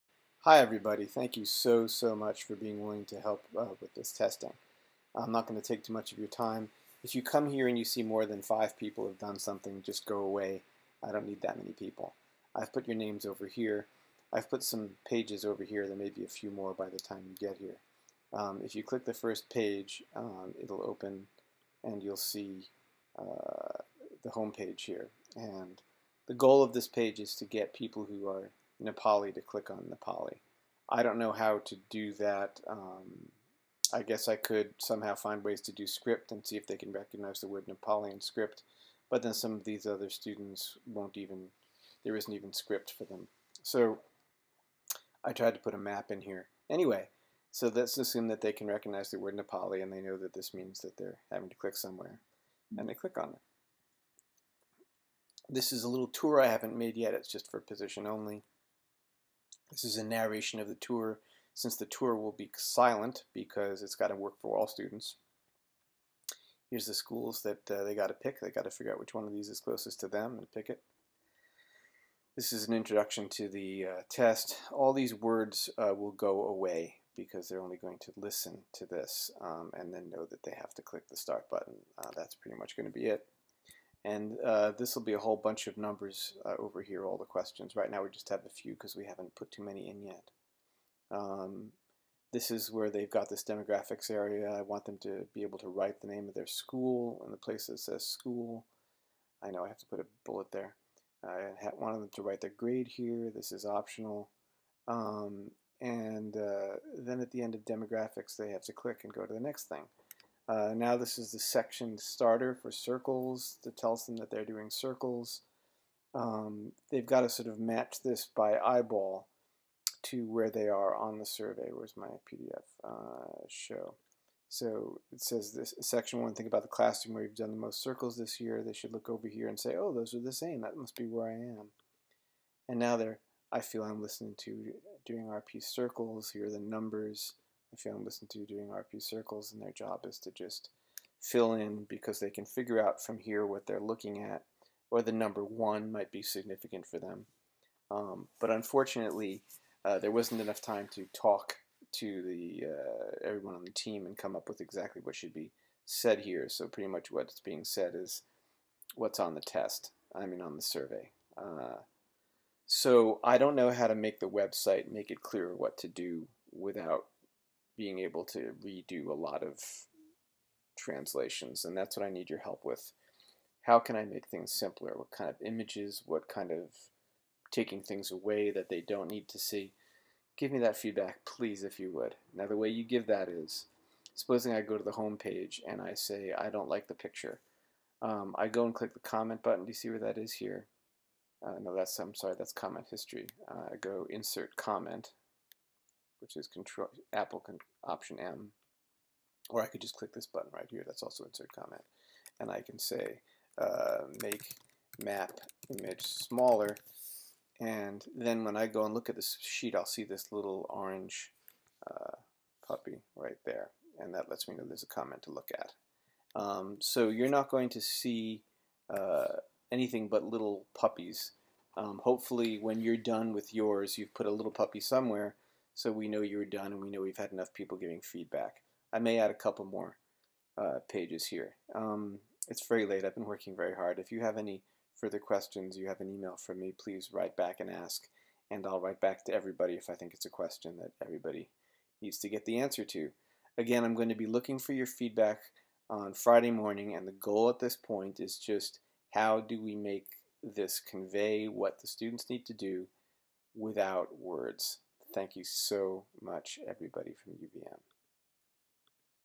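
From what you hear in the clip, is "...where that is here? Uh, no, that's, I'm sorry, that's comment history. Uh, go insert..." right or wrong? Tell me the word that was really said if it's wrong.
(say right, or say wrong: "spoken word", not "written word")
right.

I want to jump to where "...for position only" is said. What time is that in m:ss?
0:57.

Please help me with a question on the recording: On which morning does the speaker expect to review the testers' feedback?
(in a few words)
Friday.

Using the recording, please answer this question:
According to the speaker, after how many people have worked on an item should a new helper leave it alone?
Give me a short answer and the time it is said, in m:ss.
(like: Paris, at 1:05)
5, at 0:08.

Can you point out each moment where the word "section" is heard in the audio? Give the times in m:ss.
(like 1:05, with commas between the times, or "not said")
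1:51, 2:05.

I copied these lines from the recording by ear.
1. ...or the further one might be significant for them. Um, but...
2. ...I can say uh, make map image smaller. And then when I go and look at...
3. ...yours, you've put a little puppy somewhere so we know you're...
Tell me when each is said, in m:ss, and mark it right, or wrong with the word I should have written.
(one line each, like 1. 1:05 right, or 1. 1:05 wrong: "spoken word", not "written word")
1. 2:24 wrong: "number", not "further"
2. 3:22 right
3. 3:43 right.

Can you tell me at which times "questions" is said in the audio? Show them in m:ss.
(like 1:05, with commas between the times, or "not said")
1:27, 3:55, 4:00.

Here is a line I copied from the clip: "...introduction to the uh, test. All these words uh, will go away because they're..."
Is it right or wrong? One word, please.
right.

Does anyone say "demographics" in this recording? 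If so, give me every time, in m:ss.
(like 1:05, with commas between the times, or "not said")
1:33, 1:47.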